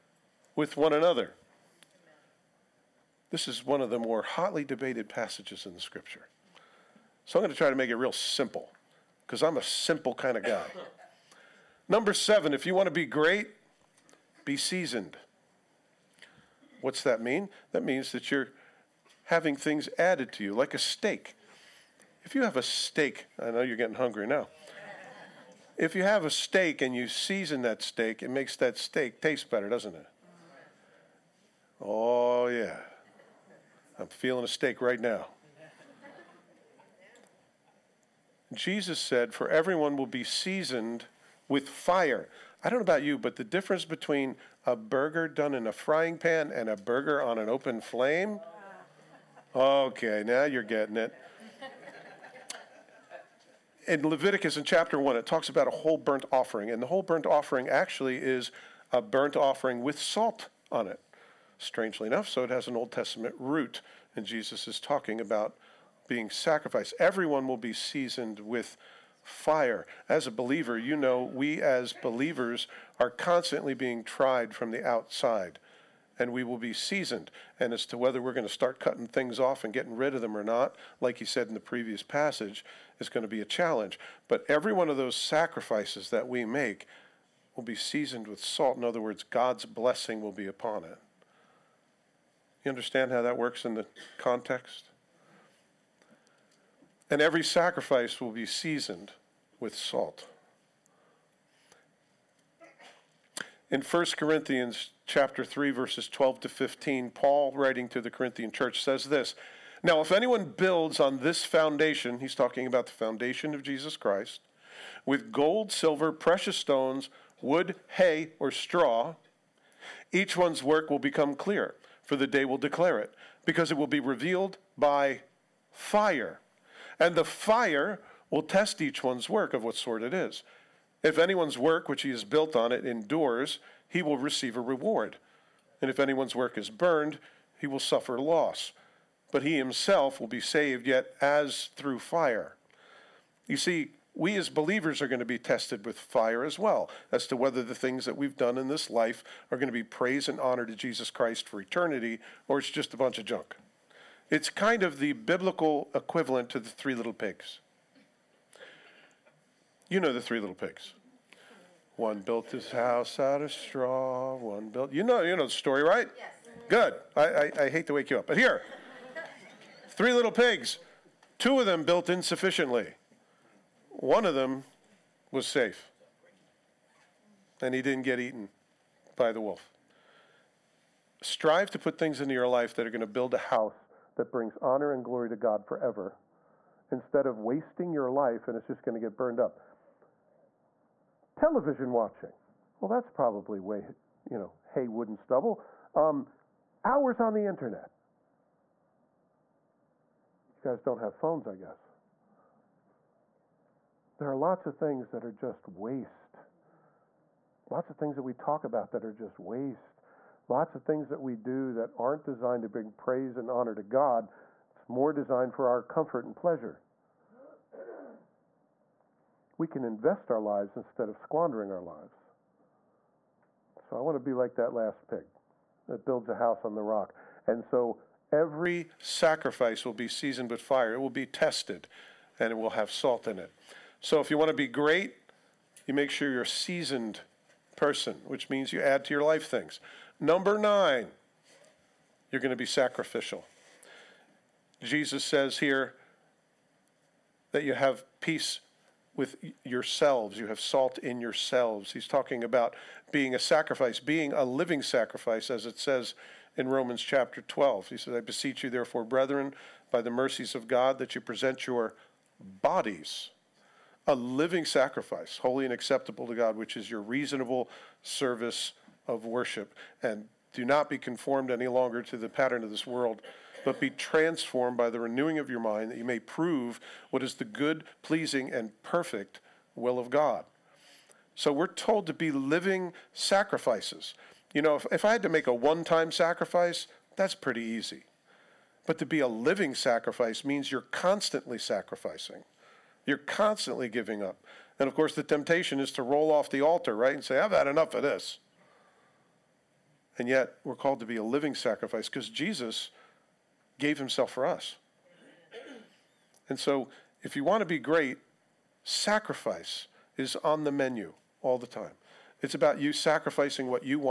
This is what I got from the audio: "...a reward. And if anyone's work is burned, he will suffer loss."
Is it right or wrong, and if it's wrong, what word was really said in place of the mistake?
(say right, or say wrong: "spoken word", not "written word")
right.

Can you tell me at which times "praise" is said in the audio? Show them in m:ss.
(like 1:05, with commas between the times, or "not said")
2:29, 3:32.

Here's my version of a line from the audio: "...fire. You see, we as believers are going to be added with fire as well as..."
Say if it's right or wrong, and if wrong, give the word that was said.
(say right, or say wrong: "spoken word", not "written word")
wrong: "tested", not "added".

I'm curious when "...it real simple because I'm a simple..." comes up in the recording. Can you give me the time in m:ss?
0:07.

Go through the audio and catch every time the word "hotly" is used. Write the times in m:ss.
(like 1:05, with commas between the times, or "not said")
0:04.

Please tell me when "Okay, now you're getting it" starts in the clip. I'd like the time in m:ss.
0:49.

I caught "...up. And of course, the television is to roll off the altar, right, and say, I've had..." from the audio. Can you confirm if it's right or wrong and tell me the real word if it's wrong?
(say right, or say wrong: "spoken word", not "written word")
wrong: "temptation", not "television".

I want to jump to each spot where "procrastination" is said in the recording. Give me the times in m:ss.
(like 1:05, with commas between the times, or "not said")
not said.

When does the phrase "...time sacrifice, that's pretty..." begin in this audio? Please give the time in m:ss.
4:45.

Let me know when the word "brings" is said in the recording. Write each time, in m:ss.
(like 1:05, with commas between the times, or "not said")
3:04, 3:32.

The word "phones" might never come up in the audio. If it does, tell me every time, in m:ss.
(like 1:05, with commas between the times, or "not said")
3:21.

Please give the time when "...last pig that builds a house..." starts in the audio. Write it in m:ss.
3:44.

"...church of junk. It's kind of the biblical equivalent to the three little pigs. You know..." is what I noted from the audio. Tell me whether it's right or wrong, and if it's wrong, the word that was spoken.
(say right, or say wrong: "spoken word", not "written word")
wrong: "bunch", not "church".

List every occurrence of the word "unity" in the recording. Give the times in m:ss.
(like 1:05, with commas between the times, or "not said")
not said.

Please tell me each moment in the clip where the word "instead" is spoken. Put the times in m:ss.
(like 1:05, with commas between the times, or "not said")
3:06, 3:40.